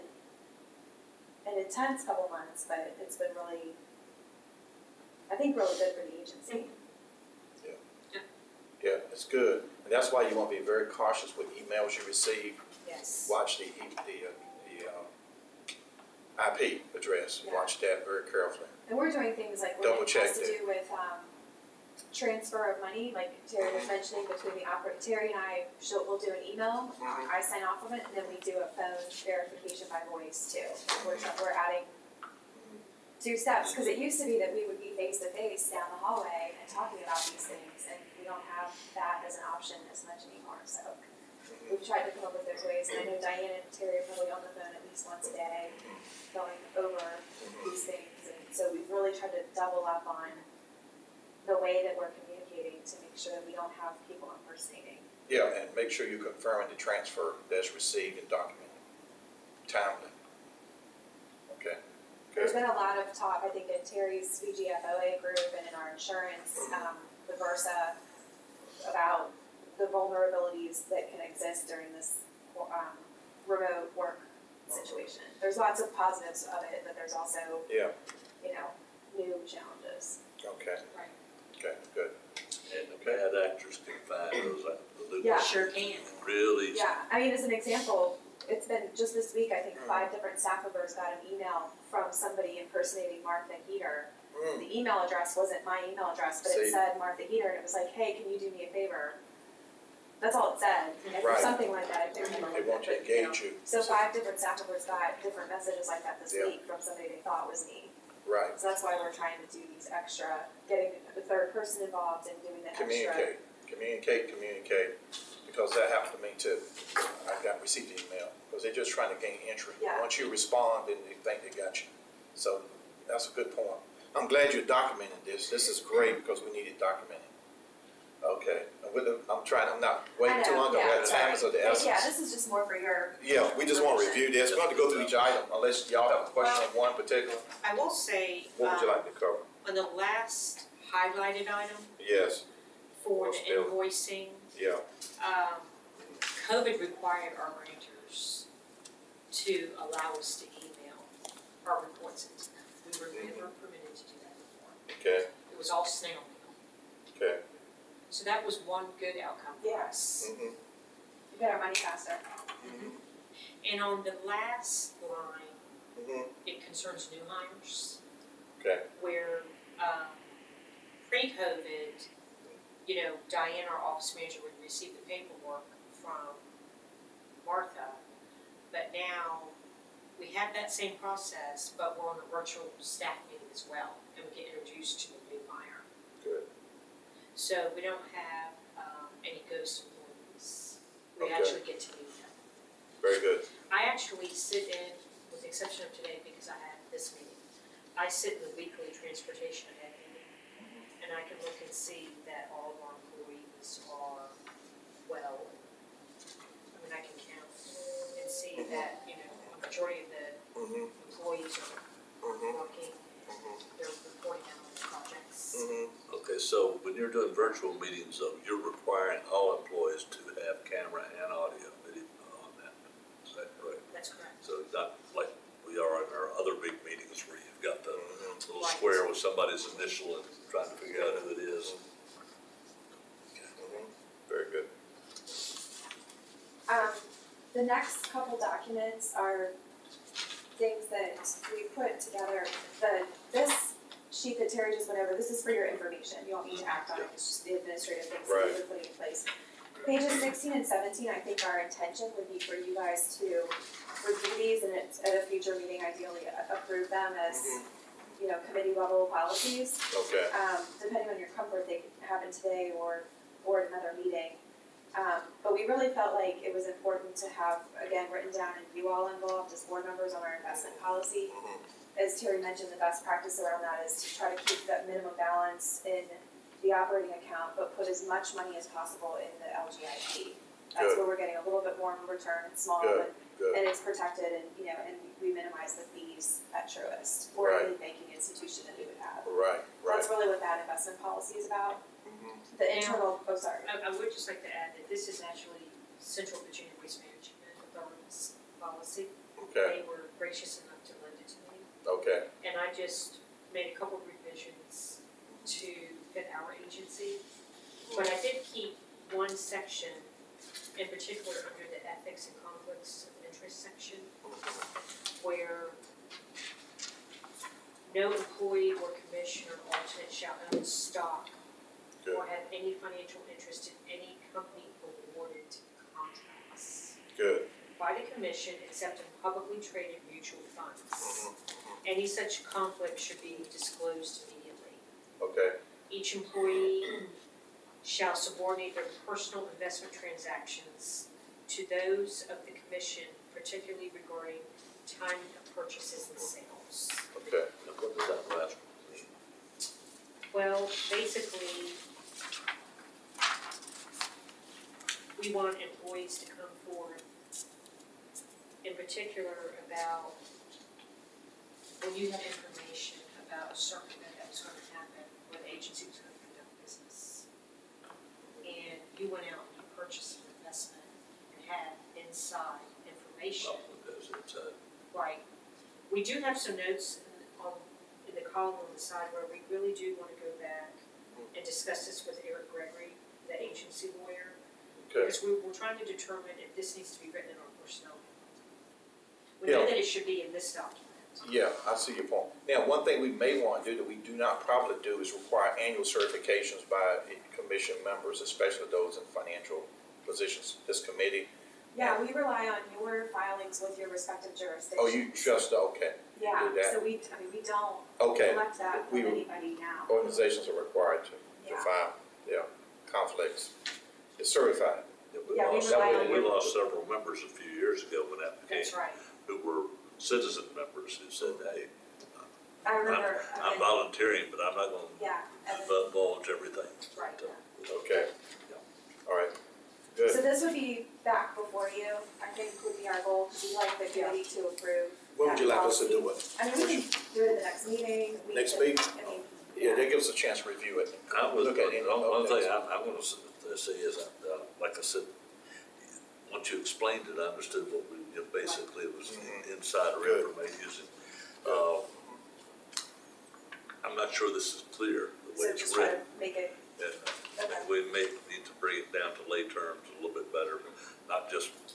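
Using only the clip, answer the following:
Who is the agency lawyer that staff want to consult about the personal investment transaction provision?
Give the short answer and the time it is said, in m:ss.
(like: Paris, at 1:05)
Eric Gregory, at 6:22.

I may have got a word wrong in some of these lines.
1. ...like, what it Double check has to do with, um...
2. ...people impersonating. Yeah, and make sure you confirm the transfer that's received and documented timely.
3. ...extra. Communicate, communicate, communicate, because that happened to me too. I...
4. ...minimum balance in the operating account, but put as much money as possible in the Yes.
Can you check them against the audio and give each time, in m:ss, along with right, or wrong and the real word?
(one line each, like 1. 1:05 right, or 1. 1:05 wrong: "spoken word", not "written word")
1. 0:19 right
2. 0:54 right
3. 1:52 right
4. 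4:34 wrong: "LGIP", not "Yes".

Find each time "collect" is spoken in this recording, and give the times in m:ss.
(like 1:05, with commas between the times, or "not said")
6:48.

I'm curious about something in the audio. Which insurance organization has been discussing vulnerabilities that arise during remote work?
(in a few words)
VRSA.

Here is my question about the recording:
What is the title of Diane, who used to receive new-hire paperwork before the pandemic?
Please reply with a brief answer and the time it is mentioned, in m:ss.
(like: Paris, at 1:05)
office manager, at 2:53.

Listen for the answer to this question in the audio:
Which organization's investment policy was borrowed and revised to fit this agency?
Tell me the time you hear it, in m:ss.
4:55.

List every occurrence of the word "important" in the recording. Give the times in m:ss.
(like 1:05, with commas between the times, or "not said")
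4:26.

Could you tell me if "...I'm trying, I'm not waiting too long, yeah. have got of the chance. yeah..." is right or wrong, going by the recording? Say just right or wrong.
wrong.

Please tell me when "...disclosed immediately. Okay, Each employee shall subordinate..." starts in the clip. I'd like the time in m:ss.
5:33.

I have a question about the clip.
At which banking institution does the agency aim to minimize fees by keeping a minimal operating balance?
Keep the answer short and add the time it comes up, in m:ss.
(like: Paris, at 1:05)
Truist, at 4:46.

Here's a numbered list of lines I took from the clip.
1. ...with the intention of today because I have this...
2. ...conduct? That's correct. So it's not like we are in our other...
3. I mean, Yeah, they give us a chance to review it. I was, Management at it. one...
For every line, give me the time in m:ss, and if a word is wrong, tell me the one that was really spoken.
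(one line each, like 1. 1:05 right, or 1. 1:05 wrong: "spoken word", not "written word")
1. 3:15 wrong: "exception", not "intention"
2. 3:43 wrong: "correct", not "conduct"
3. 7:19 wrong: "Look", not "Management".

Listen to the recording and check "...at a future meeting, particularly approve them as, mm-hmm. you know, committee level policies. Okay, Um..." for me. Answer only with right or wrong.
wrong.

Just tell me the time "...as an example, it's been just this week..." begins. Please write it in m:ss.
1:27.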